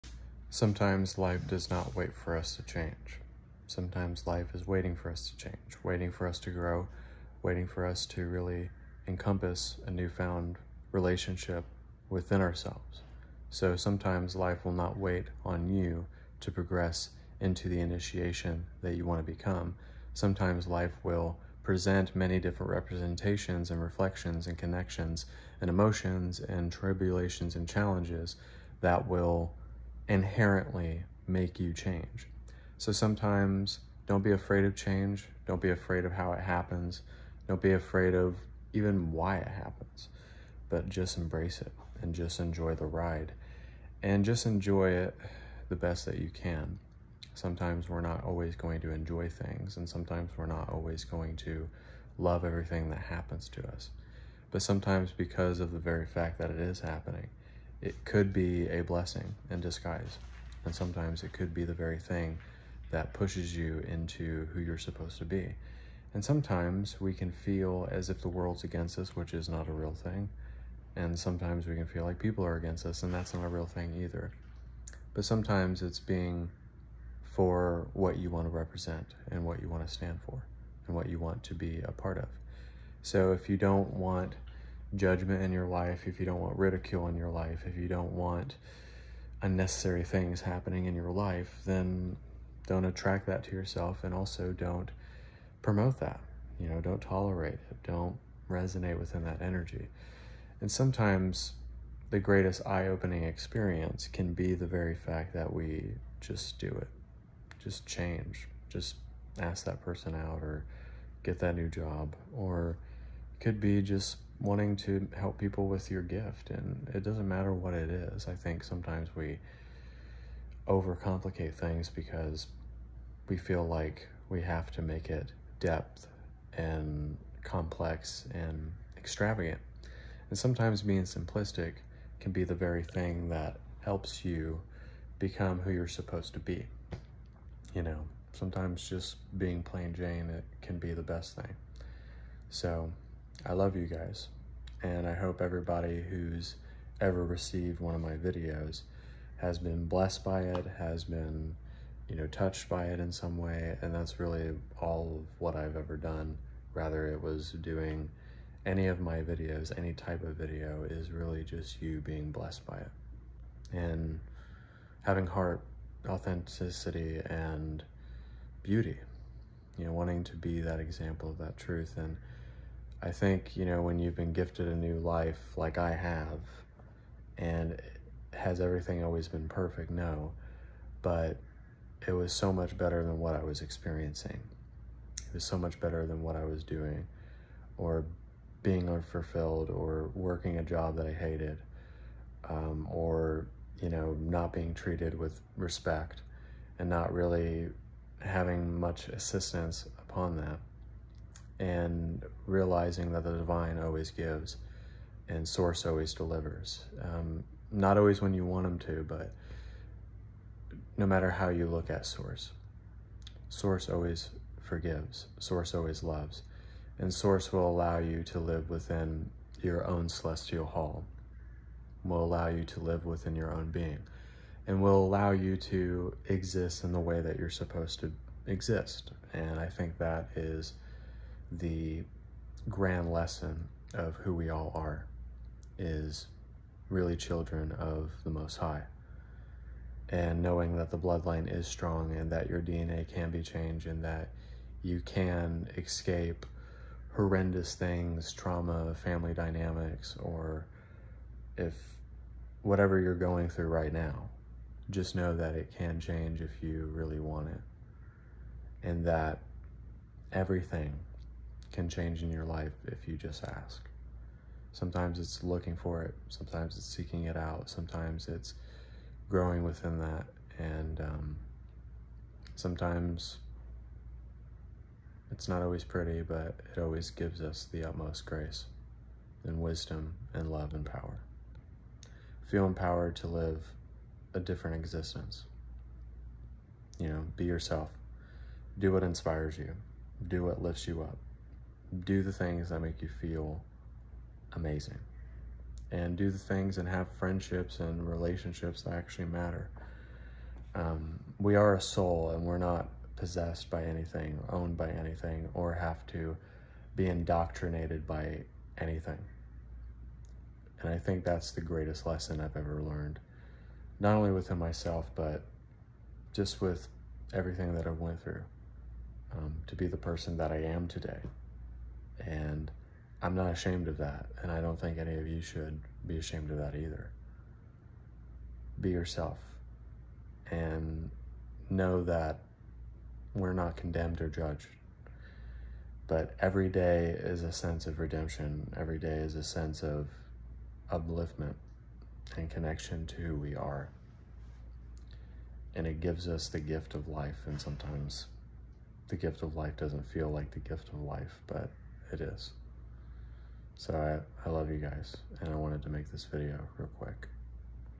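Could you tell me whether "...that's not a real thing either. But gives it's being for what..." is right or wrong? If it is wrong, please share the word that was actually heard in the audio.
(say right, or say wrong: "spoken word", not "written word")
wrong: "sometimes", not "gives".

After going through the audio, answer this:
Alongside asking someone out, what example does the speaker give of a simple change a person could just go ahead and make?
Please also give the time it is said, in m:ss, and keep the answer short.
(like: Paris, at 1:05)
get that new job, at 1:51.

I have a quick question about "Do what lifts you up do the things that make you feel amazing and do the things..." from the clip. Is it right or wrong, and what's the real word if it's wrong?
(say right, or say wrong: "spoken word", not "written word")
right.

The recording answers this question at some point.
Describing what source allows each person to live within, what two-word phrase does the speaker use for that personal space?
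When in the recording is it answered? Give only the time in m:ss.
3:40.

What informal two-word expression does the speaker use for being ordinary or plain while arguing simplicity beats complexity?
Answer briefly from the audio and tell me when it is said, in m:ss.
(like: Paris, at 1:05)
plain jane, at 2:19.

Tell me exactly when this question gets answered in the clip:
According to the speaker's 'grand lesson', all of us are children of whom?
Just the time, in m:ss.
3:58.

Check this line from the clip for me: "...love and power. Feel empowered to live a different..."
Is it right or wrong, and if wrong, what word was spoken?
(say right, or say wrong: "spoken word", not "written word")
right.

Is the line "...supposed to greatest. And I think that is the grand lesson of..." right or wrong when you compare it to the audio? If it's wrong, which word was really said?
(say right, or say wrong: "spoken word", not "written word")
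wrong: "exist", not "greatest".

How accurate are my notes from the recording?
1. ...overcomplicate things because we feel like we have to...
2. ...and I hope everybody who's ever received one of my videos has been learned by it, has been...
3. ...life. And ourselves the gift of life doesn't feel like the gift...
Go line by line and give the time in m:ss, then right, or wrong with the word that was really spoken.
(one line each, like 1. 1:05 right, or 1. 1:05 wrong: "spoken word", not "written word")
1. 2:00 right
2. 2:24 wrong: "blessed", not "learned"
3. 5:47 wrong: "sometimes", not "ourselves".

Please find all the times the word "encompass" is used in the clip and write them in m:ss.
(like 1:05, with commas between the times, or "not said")
0:09.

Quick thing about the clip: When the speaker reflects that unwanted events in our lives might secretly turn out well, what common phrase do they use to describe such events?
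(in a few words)
blessing in disguise.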